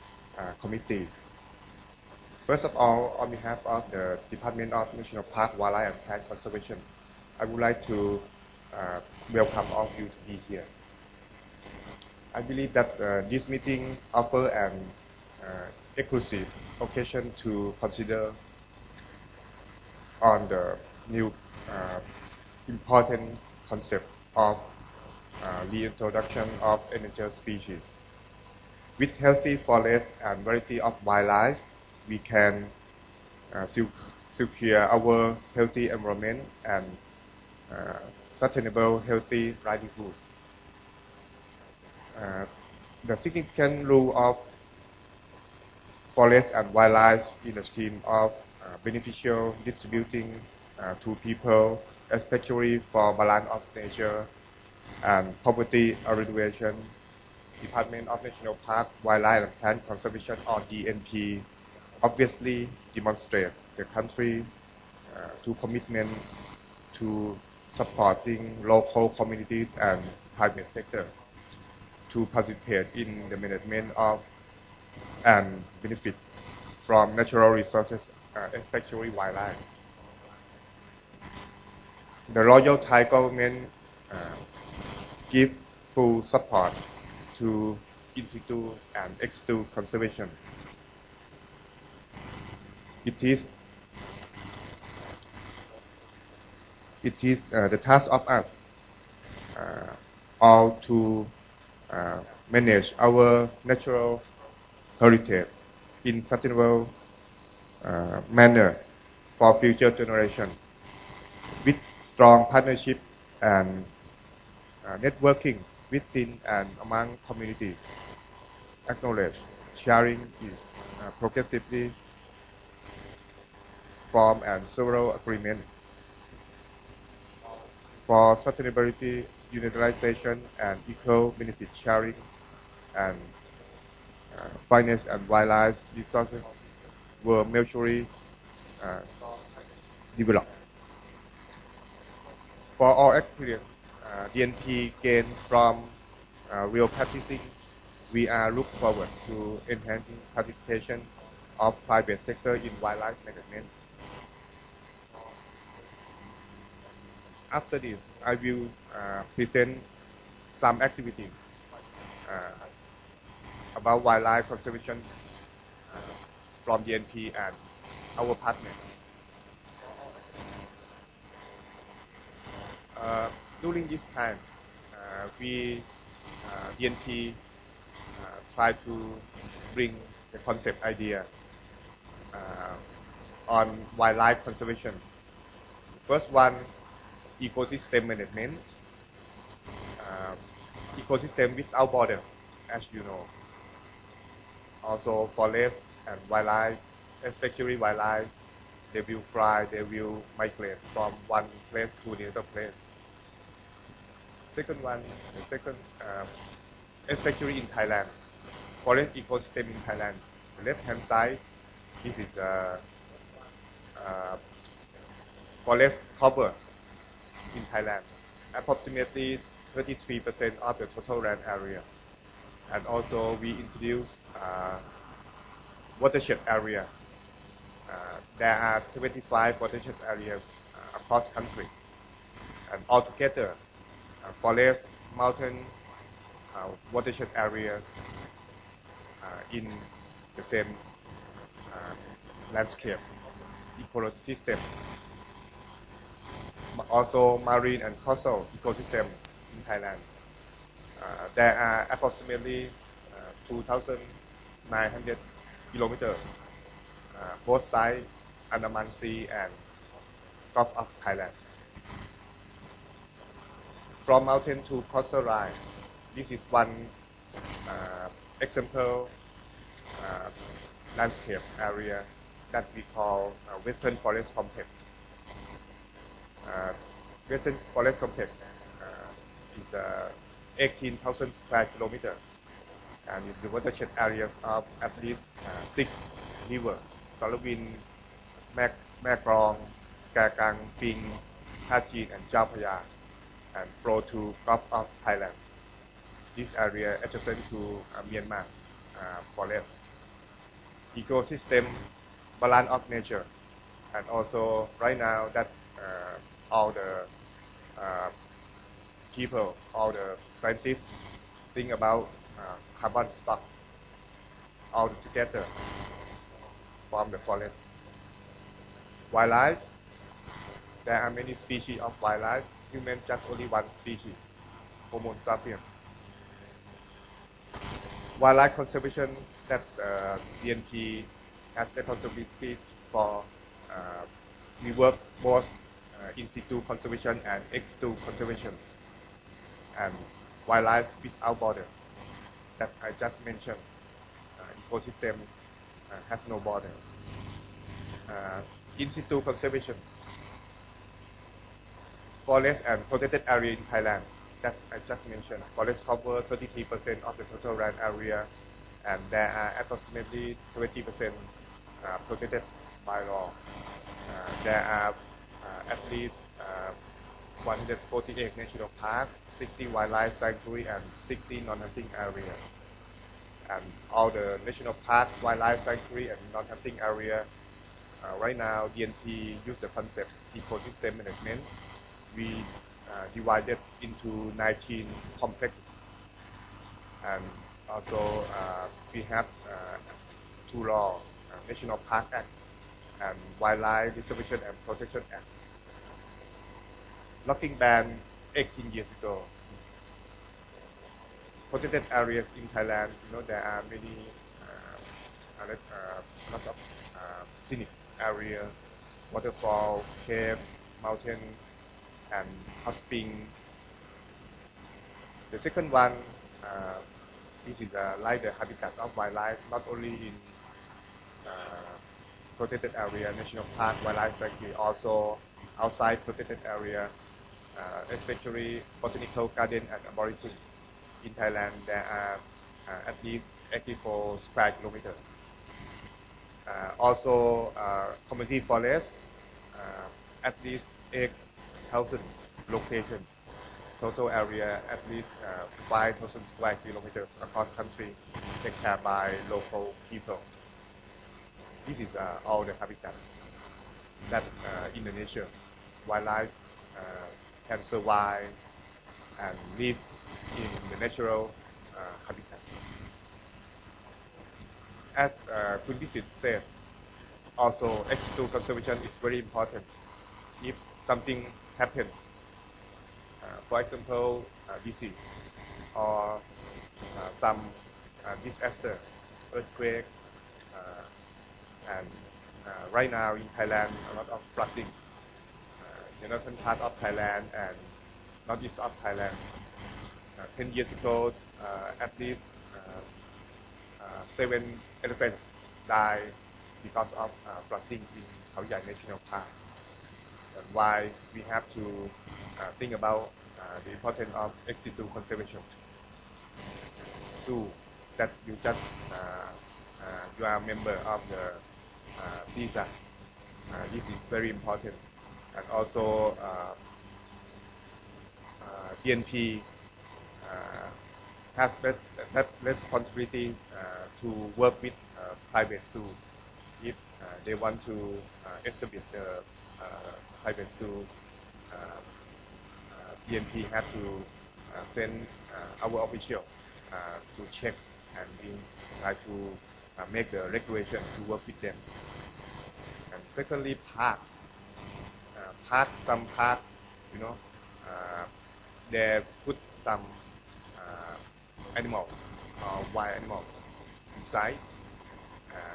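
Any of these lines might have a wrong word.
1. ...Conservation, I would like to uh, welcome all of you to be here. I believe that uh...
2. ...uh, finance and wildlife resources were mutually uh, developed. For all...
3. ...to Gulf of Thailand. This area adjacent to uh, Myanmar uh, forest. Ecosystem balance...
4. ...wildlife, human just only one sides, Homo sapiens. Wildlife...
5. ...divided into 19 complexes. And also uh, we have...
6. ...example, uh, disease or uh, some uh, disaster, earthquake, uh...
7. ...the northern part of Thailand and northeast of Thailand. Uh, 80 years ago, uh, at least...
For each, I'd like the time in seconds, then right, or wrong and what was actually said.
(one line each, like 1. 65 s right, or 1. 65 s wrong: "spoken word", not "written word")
1. 6 s right
2. 134 s right
3. 294 s right
4. 321 s wrong: "species", not "sides"
5. 383 s right
6. 473 s right
7. 486 s wrong: "10", not "80".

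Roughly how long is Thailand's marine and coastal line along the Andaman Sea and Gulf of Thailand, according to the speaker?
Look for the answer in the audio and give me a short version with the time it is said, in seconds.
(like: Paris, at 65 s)
2,900 kilometers, at 253 s.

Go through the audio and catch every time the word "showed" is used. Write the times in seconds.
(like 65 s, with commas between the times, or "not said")
not said.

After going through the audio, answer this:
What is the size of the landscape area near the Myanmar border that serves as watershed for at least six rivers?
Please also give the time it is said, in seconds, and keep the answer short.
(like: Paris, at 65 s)
18,000 square kilometers, at 280 s.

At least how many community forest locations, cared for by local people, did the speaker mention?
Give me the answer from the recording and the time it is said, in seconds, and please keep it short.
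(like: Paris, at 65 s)
8,000, at 440 s.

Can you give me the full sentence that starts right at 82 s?
The Royal Thai government uh, give full support to in-situ and ex-situ conservation.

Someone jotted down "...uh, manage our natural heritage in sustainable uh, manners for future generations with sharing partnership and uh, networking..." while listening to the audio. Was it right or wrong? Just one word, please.
wrong.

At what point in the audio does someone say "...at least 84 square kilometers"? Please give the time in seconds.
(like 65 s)
432 s.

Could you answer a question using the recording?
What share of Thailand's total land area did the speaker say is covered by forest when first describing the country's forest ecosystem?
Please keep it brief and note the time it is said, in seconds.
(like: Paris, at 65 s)
approximately 33%, at 218 s.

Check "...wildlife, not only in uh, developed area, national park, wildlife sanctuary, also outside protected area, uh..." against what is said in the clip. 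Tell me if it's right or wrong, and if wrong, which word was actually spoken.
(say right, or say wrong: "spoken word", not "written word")
wrong: "protected", not "developed".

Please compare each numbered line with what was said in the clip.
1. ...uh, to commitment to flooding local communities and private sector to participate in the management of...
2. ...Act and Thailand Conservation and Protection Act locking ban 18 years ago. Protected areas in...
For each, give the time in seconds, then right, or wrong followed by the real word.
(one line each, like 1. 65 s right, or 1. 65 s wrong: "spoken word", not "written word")
1. 65 s wrong: "supporting", not "flooding"
2. 392 s wrong: "Wildlife", not "Thailand".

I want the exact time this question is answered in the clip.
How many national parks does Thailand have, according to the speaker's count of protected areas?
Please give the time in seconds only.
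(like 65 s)
367 s.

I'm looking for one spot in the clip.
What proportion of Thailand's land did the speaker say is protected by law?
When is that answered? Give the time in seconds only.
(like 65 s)
359 s.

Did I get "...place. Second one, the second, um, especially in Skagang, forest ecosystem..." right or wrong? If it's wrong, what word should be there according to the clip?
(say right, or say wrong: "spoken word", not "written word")
wrong: "Thailand", not "Skagang".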